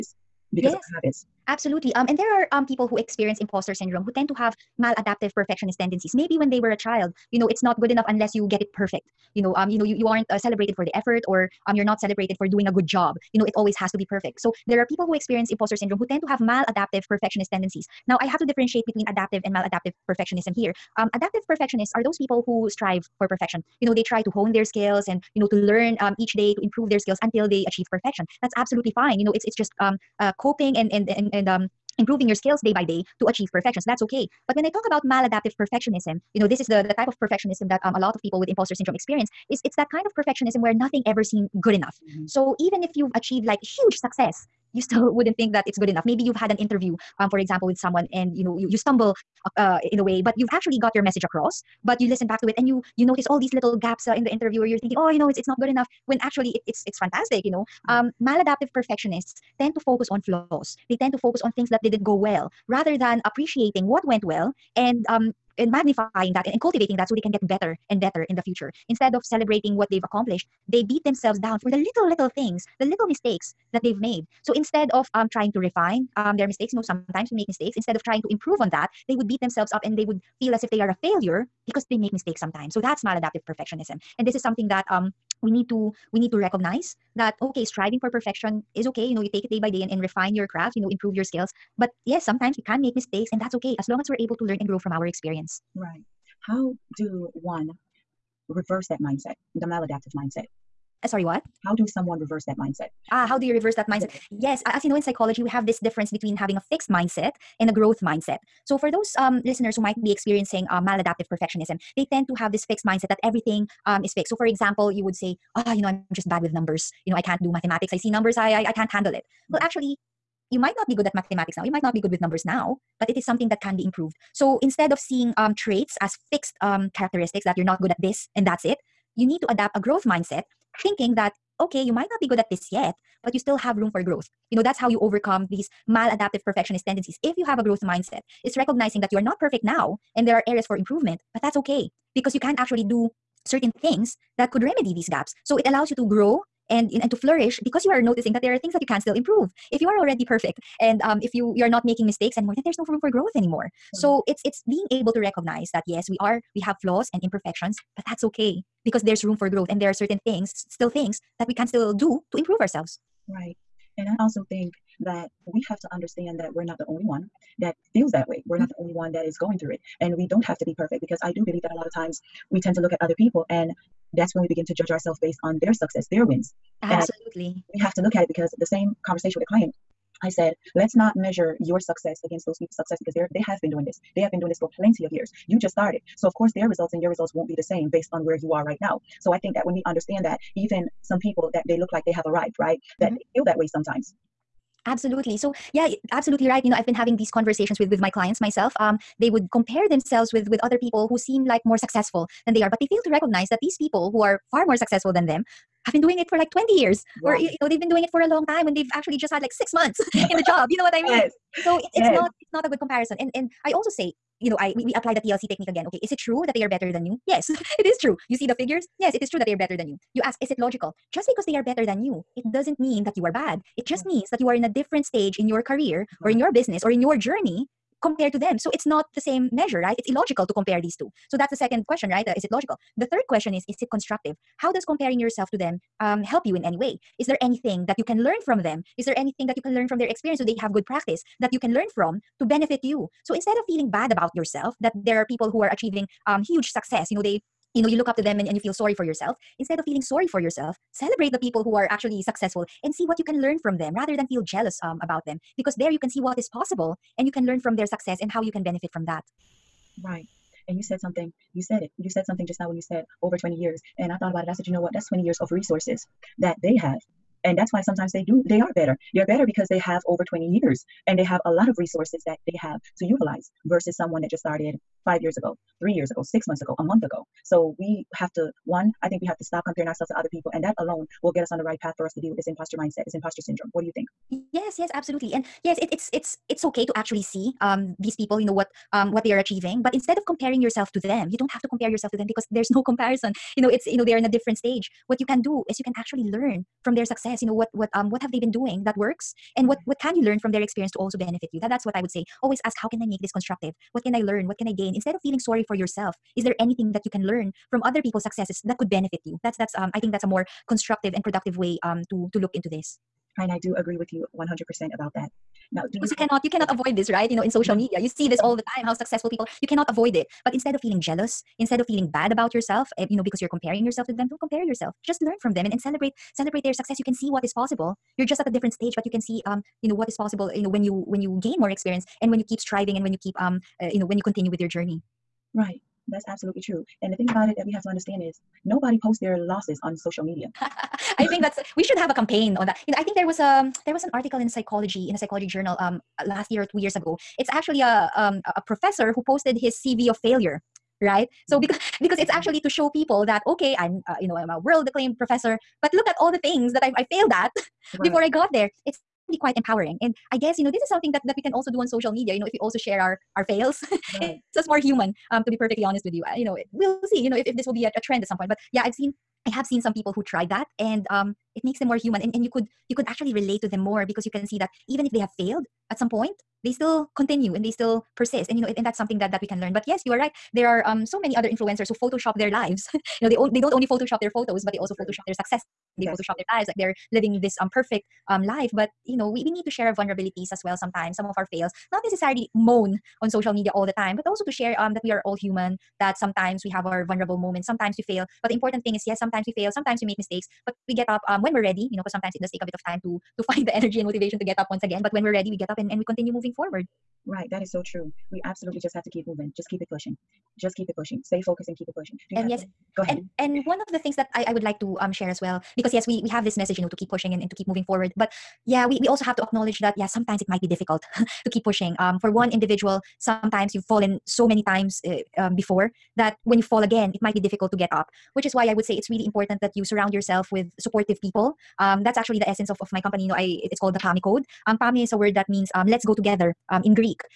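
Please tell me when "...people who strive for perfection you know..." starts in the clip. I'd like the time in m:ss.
0:22.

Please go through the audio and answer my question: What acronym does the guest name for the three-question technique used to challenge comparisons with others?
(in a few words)
TLC.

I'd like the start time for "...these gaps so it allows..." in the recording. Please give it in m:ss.
2:24.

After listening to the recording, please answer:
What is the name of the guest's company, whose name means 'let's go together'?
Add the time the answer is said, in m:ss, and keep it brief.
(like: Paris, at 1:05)
PAME code, at 7:13.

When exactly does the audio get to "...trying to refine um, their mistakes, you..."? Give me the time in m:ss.
1:15.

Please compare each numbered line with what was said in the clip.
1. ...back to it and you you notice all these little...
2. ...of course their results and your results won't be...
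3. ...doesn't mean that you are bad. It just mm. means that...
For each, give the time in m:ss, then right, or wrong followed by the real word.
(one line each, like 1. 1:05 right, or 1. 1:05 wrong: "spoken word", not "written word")
1. 0:52 right
2. 3:06 right
3. 3:42 right.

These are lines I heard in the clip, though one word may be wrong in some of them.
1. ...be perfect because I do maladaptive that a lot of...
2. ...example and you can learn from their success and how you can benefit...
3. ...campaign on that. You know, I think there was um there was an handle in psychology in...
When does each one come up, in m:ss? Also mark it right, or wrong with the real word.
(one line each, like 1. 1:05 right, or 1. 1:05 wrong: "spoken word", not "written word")
1. 2:50 wrong: "believe", not "maladaptive"
2. 4:16 wrong: "possible", not "example"
3. 5:42 wrong: "article", not "handle".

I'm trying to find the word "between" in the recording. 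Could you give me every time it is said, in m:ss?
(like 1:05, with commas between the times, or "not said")
0:18, 1:46.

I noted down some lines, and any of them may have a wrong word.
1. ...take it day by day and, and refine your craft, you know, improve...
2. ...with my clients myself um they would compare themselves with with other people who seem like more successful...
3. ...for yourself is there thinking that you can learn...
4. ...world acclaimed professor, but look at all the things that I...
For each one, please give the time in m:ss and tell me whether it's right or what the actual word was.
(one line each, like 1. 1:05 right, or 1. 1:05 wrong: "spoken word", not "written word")
1. 1:29 right
2. 3:17 right
3. 5:05 wrong: "anything", not "thinking"
4. 5:54 right.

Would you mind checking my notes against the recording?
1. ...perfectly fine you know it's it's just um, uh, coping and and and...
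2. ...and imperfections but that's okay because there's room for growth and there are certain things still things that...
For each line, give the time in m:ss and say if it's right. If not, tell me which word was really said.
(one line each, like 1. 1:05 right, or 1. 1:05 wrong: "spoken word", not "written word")
1. 0:28 wrong: "absolutely", not "perfectly"
2. 2:37 right.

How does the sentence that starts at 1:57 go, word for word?
I see numbers, I, I, I can't handle it.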